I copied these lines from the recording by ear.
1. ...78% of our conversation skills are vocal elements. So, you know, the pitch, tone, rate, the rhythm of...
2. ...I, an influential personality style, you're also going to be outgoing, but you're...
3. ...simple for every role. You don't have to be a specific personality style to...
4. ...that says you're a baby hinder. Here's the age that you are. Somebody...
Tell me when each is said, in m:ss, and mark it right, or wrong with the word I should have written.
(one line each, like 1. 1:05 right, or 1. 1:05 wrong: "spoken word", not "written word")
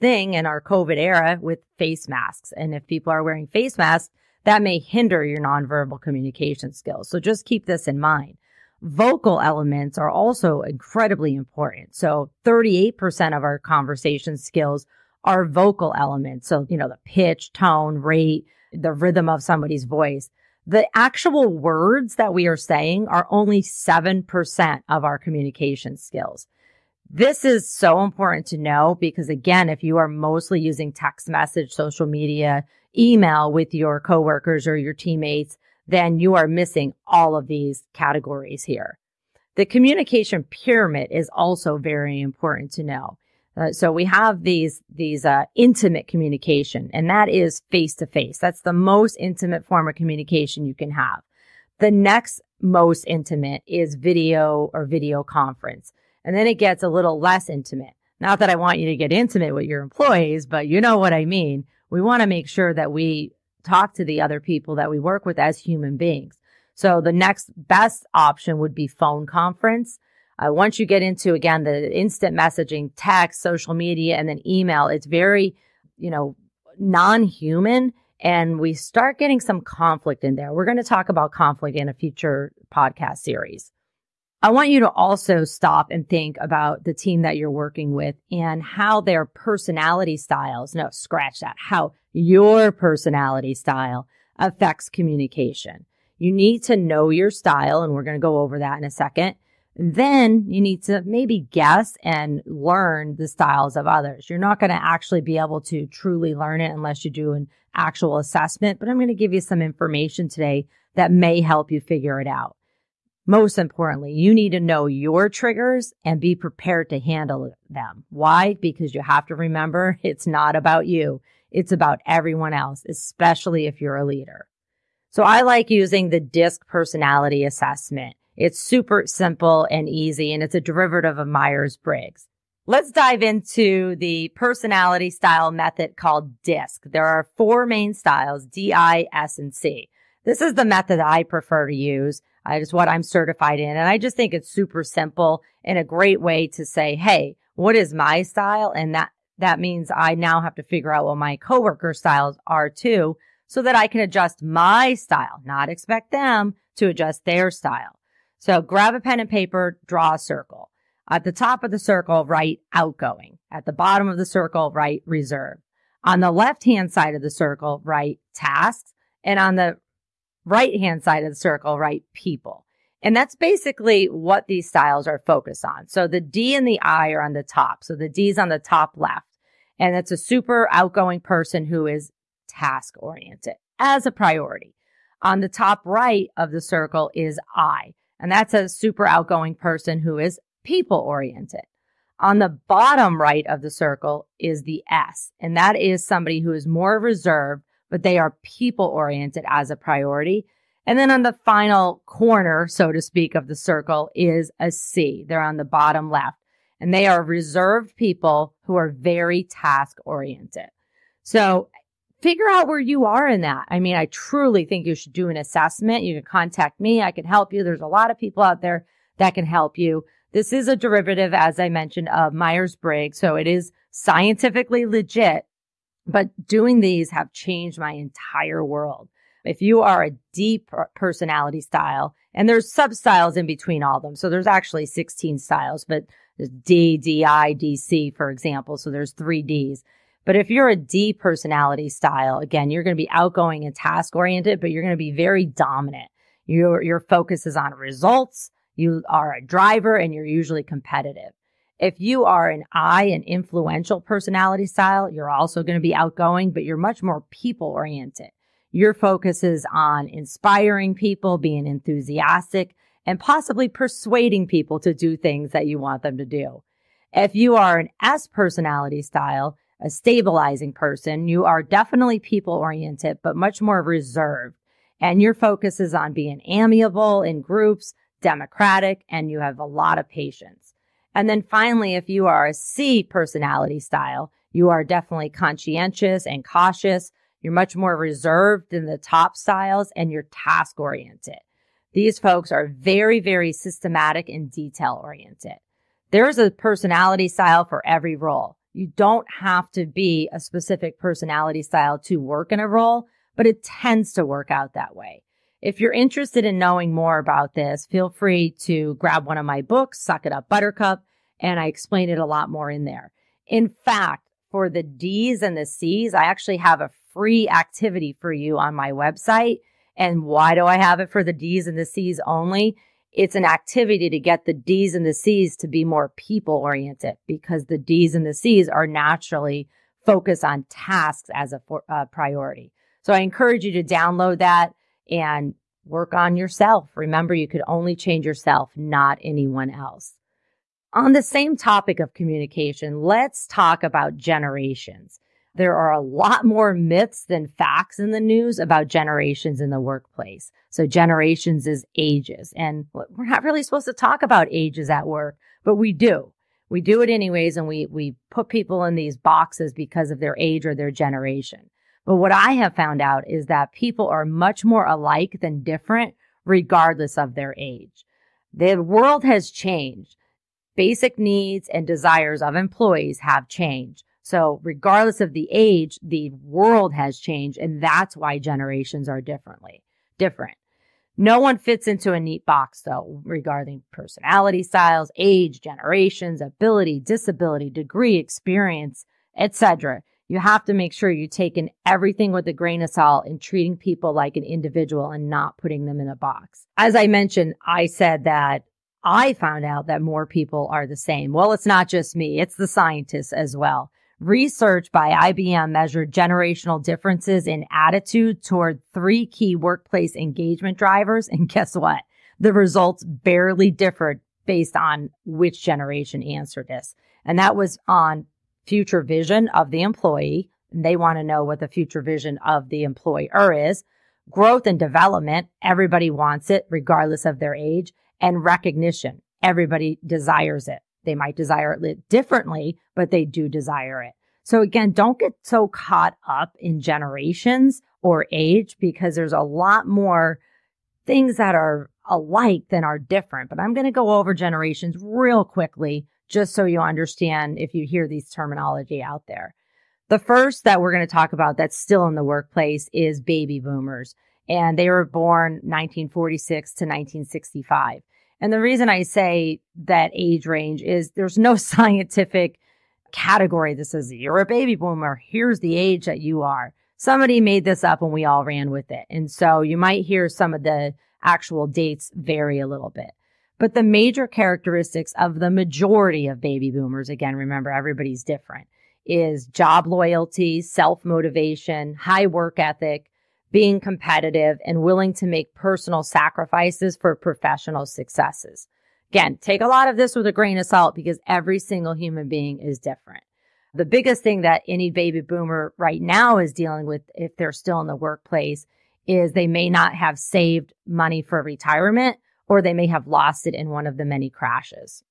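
1. 0:12 wrong: "38", not "78"
2. 4:12 right
3. 4:57 wrong: "style", not "simple"
4. 7:43 wrong: "boomer", not "hinder".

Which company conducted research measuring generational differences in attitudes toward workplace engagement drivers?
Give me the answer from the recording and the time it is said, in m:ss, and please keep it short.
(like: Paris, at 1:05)
IBM, at 6:45.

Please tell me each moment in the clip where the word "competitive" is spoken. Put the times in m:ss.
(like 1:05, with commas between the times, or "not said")
4:10, 8:03.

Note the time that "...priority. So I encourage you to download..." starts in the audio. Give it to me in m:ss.
5:32.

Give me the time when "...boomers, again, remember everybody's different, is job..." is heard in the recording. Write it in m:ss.
7:56.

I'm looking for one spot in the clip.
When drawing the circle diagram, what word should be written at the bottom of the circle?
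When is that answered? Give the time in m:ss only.
2:45.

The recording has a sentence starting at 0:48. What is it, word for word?
That's the most intimate form of communication you can have.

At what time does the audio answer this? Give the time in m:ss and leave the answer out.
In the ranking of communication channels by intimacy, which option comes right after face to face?
0:53.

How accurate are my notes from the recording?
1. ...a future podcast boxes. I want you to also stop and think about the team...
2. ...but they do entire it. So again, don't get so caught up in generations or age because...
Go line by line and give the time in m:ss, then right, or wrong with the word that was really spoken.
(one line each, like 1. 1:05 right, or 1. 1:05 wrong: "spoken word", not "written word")
1. 1:21 wrong: "series", not "boxes"
2. 7:12 wrong: "desire", not "entire".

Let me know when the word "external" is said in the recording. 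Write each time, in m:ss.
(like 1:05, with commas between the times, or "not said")
not said.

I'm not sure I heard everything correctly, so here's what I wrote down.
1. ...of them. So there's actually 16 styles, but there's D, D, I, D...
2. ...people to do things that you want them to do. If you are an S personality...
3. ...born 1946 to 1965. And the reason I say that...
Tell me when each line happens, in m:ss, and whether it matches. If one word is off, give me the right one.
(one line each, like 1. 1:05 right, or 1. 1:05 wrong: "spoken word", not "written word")
1. 3:53 right
2. 4:24 right
3. 7:35 right.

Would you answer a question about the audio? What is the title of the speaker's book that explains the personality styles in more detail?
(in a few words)
Suck It Up Buttercup.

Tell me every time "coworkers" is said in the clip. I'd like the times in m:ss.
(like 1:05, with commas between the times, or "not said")
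0:33, 2:31.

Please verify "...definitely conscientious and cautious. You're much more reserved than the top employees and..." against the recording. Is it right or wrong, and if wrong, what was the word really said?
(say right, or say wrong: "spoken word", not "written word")
wrong: "styles", not "employees".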